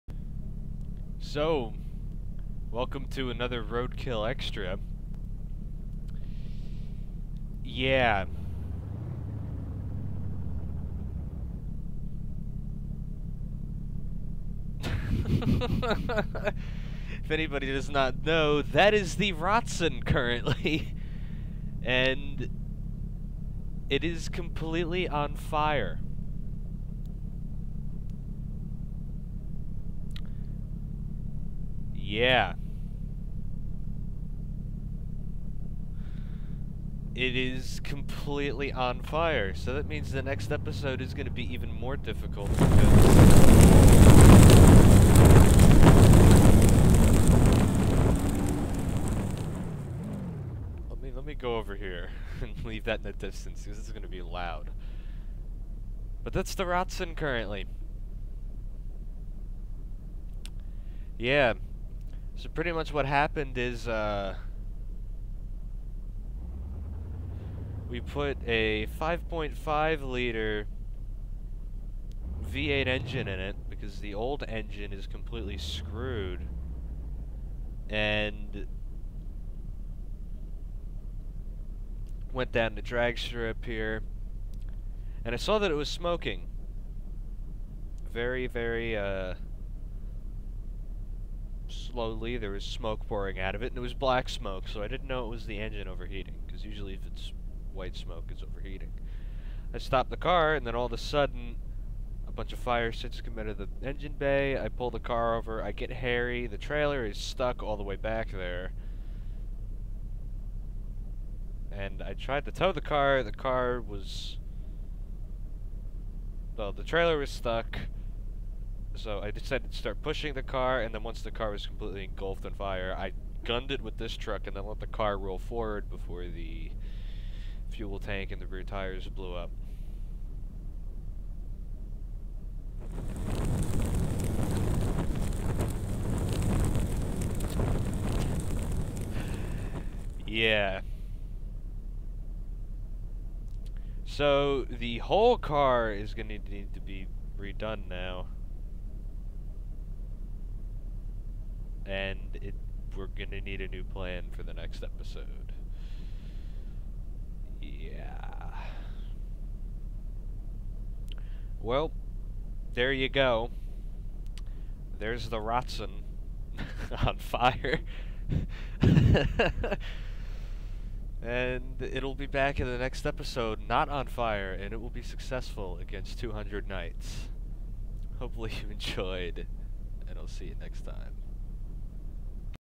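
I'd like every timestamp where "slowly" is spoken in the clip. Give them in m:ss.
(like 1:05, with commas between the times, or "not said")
1:31.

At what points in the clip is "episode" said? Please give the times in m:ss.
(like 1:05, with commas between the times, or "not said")
0:40, 2:34, 2:53.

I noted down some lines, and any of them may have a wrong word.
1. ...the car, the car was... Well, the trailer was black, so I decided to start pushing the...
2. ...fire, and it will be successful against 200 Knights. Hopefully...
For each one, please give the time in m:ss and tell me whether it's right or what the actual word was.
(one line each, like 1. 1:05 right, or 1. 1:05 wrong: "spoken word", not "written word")
1. 1:52 wrong: "stuck", not "black"
2. 2:54 right.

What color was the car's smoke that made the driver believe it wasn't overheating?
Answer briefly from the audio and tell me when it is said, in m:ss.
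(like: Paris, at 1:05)
Black, at 1:33.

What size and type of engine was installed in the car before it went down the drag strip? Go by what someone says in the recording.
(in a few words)
5.5 liter V8.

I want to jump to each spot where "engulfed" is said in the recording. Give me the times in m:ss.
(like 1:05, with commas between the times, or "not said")
2:02.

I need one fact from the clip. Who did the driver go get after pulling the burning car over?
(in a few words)
Harry.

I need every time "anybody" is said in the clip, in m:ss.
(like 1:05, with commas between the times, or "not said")
0:17.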